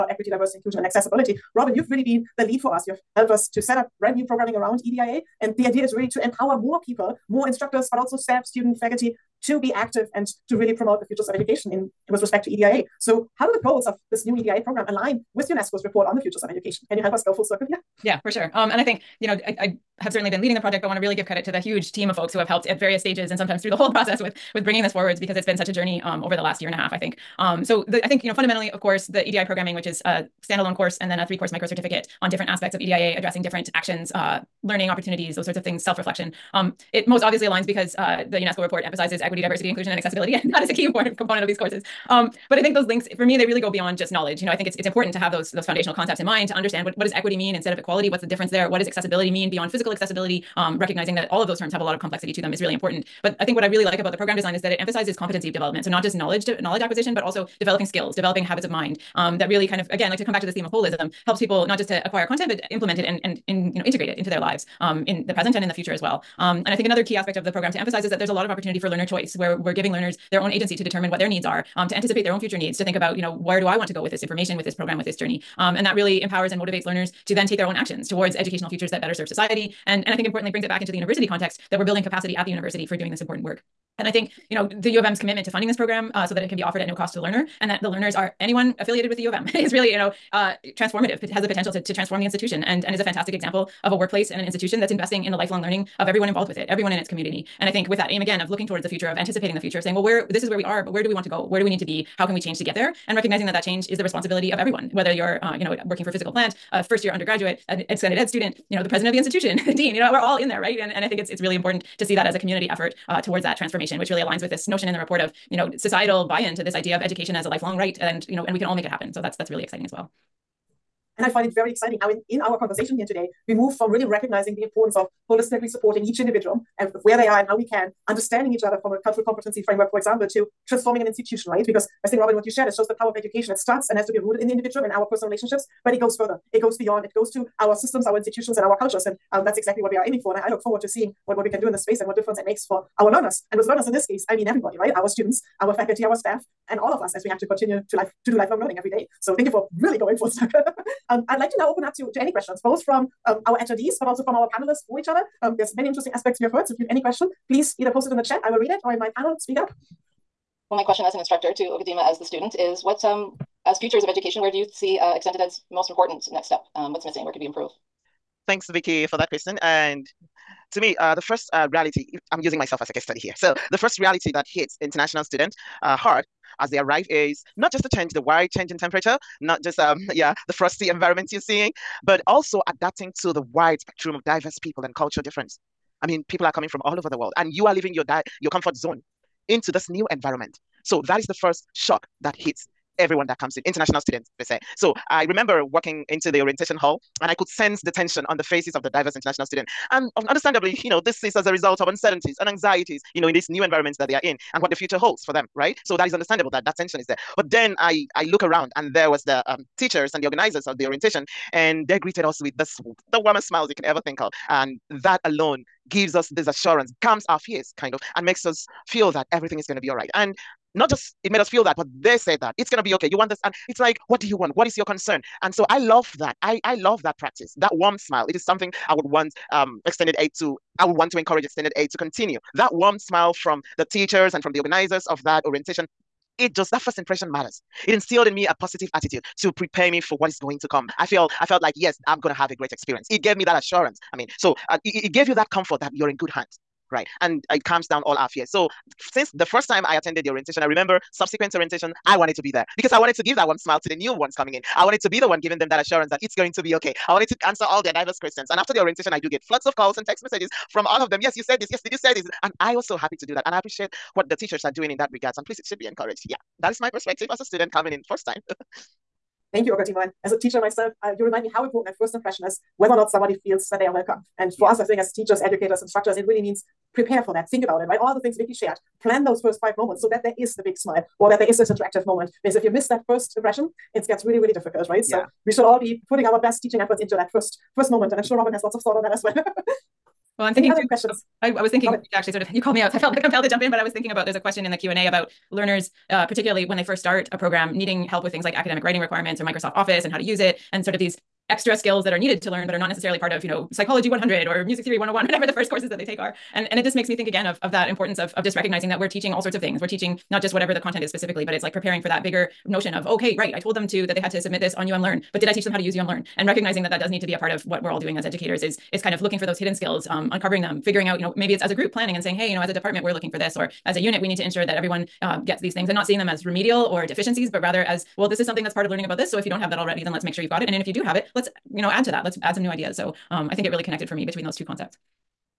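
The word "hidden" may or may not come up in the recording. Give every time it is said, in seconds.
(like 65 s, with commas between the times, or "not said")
319 s.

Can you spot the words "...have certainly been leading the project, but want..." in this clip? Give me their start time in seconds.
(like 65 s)
20 s.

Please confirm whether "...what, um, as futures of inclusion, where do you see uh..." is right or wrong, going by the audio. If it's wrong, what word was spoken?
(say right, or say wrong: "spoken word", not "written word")
wrong: "education", not "inclusion".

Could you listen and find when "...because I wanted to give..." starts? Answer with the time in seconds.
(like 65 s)
252 s.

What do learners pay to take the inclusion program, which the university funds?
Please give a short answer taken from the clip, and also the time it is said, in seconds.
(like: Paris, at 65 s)
no cost, at 86 s.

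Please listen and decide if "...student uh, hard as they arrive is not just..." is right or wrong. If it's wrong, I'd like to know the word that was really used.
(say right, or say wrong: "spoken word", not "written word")
right.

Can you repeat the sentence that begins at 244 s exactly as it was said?
I mean, so uh, it, it gave you that comfort that you're in good hands, right?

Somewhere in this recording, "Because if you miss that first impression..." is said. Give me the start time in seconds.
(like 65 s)
282 s.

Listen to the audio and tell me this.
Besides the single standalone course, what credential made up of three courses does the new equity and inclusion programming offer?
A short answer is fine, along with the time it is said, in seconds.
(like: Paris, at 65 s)
micro certificate, at 31 s.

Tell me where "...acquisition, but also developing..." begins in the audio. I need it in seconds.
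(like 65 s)
56 s.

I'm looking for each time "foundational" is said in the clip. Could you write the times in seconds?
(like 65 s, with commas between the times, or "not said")
45 s.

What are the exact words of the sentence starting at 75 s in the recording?
Um, and that really empowers and motivates learners to then take their own actions towards educational futures that better serve society.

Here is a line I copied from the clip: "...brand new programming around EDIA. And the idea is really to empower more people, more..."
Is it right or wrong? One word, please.
right.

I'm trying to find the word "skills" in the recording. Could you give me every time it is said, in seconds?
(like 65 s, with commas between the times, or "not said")
57 s, 301 s, 319 s.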